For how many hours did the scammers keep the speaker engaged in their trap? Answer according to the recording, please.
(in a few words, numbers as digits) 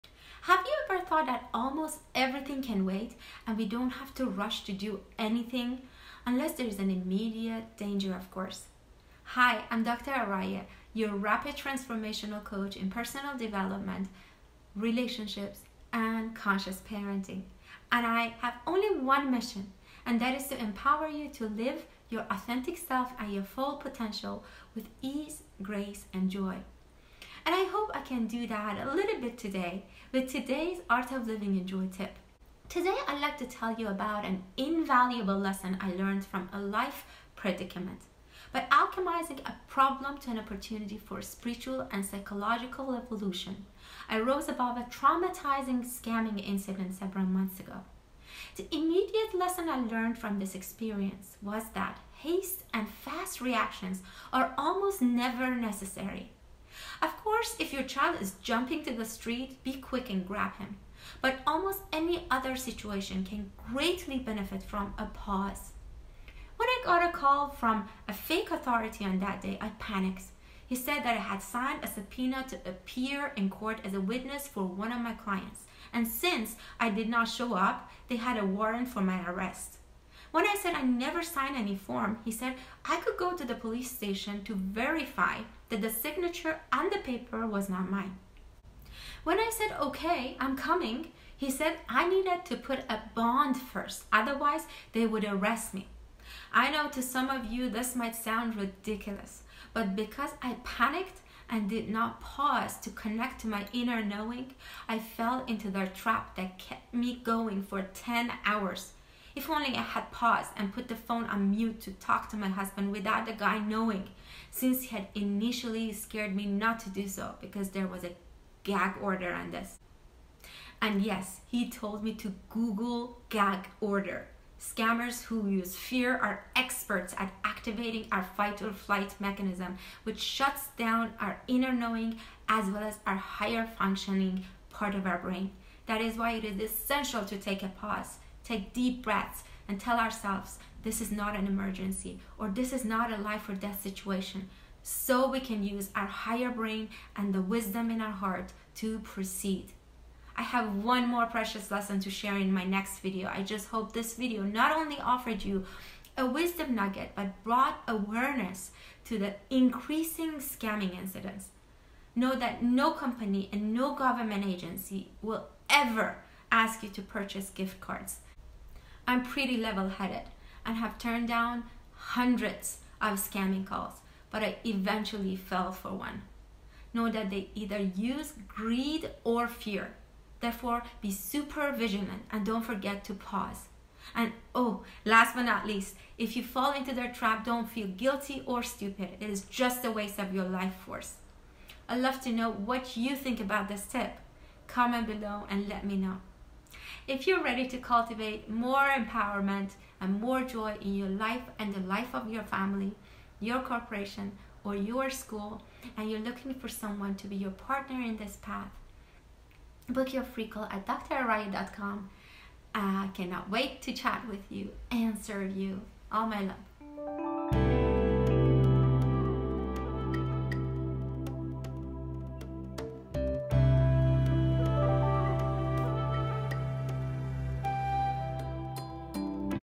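10.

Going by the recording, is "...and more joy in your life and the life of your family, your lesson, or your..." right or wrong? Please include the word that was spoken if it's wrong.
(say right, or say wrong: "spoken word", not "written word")
wrong: "corporation", not "lesson".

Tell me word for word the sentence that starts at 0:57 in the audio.
Of course, if your child is jumping to the street, be quick and grab him.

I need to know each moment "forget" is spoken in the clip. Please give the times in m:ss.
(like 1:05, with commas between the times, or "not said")
3:02.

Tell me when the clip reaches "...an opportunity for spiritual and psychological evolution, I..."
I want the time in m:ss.
0:40.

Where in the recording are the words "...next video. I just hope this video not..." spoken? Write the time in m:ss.
2:32.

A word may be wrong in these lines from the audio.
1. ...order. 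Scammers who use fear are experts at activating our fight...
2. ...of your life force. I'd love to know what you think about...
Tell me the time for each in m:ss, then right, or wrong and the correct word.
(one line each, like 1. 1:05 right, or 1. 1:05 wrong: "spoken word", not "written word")
1. 2:03 right
2. 3:10 right.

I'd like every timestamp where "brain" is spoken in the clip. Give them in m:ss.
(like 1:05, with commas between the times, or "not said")
2:15, 2:26.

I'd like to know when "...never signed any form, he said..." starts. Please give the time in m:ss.
1:20.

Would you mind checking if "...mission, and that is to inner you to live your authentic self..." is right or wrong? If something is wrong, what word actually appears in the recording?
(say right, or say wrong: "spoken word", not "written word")
wrong: "empower", not "inner".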